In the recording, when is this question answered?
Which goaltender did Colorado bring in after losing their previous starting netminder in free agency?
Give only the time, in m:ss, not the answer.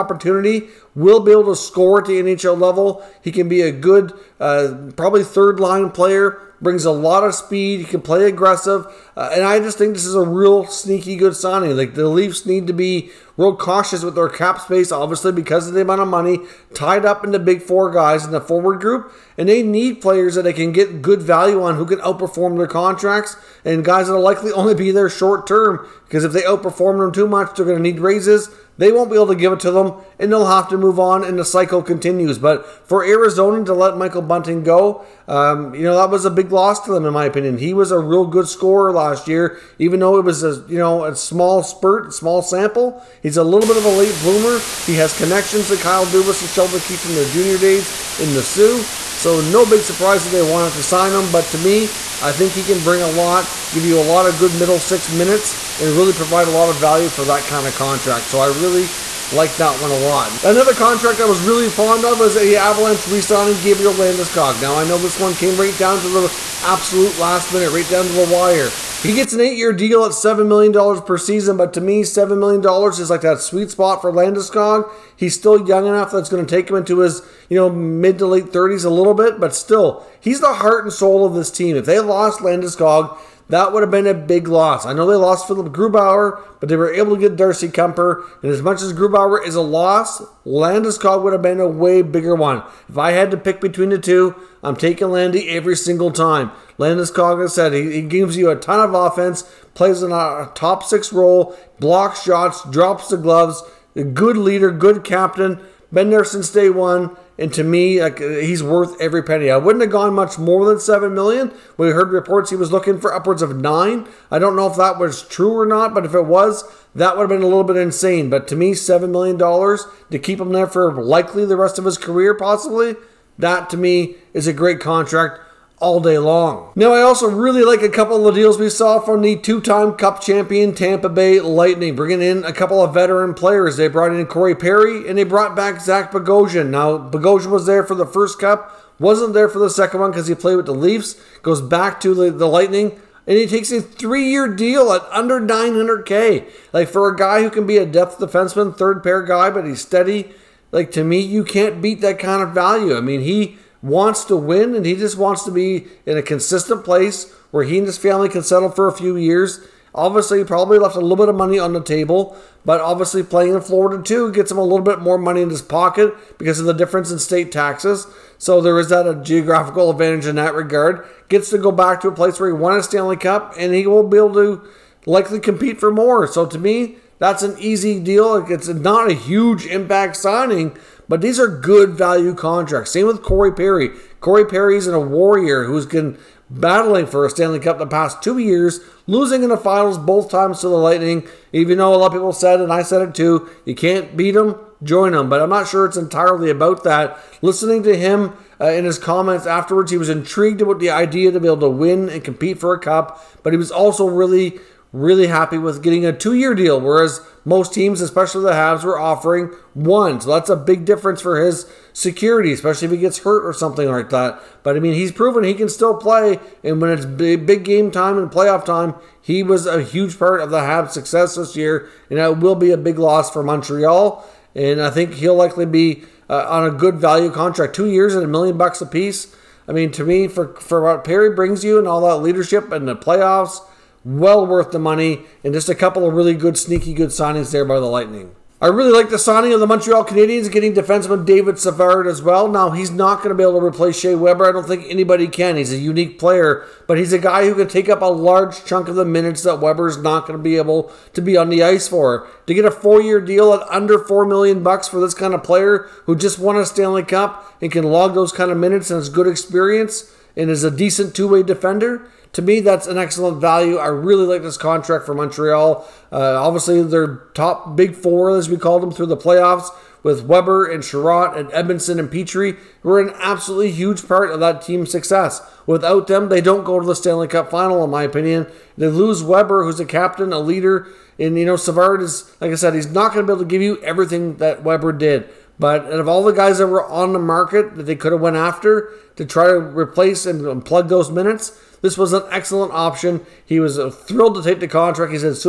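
1:27.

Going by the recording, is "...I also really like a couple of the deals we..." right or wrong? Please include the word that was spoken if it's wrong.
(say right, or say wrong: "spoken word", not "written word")
right.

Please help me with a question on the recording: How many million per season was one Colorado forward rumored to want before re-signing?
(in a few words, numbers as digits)
9.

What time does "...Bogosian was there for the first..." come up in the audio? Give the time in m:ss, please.
2:16.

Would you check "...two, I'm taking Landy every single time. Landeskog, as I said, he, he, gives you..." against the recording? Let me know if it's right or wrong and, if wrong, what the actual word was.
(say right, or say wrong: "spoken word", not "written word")
right.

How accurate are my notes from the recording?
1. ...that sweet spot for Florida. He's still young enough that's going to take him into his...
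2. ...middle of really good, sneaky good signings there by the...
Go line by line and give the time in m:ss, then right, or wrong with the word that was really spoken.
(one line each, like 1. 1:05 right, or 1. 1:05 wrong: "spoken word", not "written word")
1. 1:13 wrong: "Landeskog", not "Florida"
2. 3:55 wrong: "couple", not "middle".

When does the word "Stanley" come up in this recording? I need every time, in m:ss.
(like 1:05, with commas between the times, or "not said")
2:52, 3:07, 4:16, 4:36.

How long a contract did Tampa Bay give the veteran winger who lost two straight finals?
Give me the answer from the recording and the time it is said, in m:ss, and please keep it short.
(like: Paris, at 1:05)
2 years, at 3:26.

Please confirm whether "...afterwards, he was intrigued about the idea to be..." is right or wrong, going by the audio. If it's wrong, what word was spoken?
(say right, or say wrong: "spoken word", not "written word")
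right.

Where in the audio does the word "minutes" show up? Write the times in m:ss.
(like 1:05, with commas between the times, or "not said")
0:55, 1:07, 4:09, 4:18, 4:51.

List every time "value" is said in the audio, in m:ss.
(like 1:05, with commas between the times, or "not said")
0:21, 0:56, 2:32, 3:01, 3:46, 4:23.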